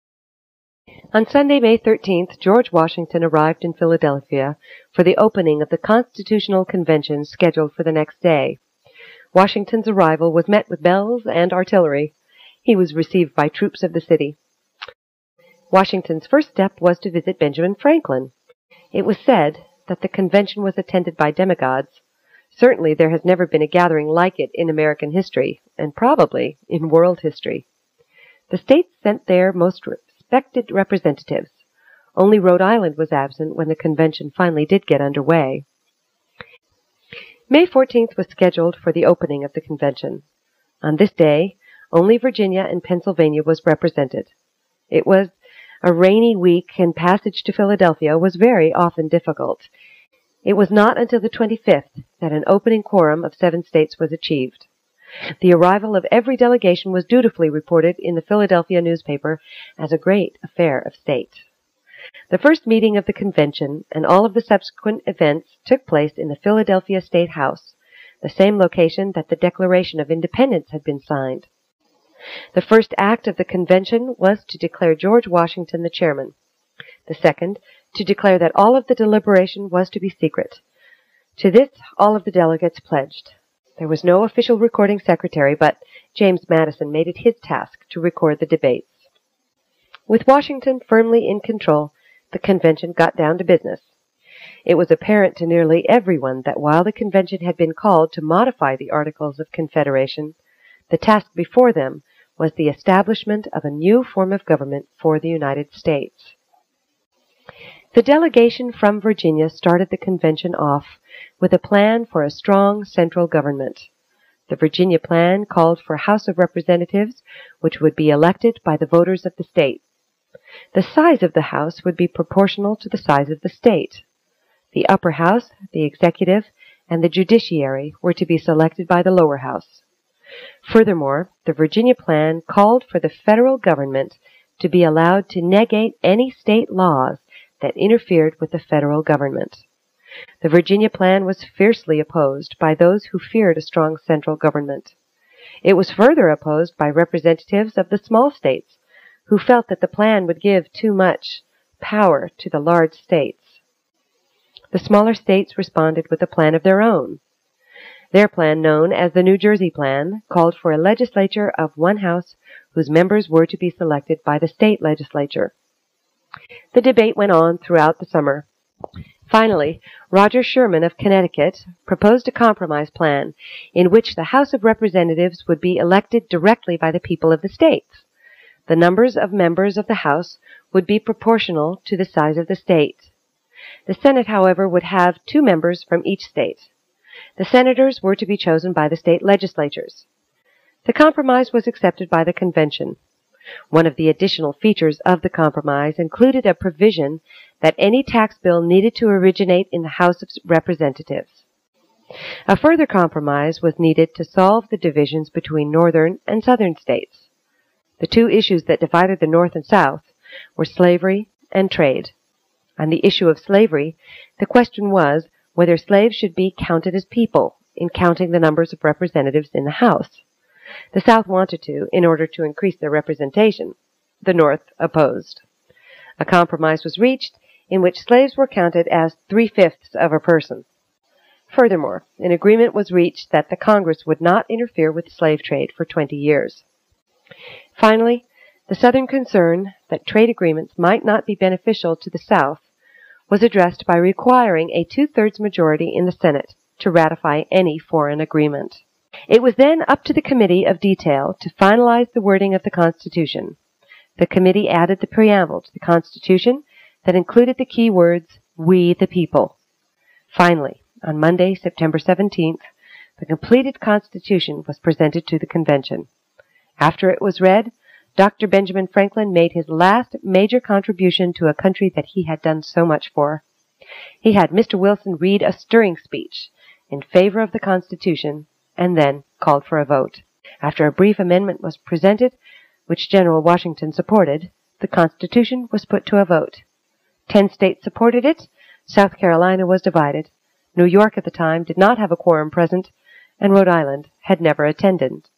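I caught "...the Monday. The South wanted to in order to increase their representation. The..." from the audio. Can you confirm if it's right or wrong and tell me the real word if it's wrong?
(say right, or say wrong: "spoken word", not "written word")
wrong: "House", not "Monday".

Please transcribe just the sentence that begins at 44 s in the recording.
It was a rainy week and passage to Philadelphia was very often difficult.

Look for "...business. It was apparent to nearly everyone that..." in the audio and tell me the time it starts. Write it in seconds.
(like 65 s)
93 s.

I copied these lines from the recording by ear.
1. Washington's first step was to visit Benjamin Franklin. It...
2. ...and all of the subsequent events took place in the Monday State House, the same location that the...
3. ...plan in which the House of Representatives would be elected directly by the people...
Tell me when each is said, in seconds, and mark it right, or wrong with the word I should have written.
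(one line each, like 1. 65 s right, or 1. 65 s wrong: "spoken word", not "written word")
1. 15 s right
2. 63 s wrong: "Philadelphia", not "Monday"
3. 172 s right.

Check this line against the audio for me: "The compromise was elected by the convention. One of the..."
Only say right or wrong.
wrong.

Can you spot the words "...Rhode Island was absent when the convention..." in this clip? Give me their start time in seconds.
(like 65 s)
32 s.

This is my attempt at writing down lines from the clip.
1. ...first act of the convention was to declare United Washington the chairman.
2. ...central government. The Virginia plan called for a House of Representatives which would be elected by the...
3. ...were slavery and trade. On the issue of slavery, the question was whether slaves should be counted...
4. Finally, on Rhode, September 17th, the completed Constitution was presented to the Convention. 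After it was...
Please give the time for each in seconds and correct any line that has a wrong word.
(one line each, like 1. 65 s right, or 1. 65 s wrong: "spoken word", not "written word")
1. 72 s wrong: "George", not "United"
2. 112 s right
3. 210 s right
4. 260 s wrong: "Monday", not "Rhode".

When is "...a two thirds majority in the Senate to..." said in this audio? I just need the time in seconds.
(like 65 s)
244 s.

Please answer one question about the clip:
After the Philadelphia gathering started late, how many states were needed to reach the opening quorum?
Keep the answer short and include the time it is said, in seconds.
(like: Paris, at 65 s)
7, at 53 s.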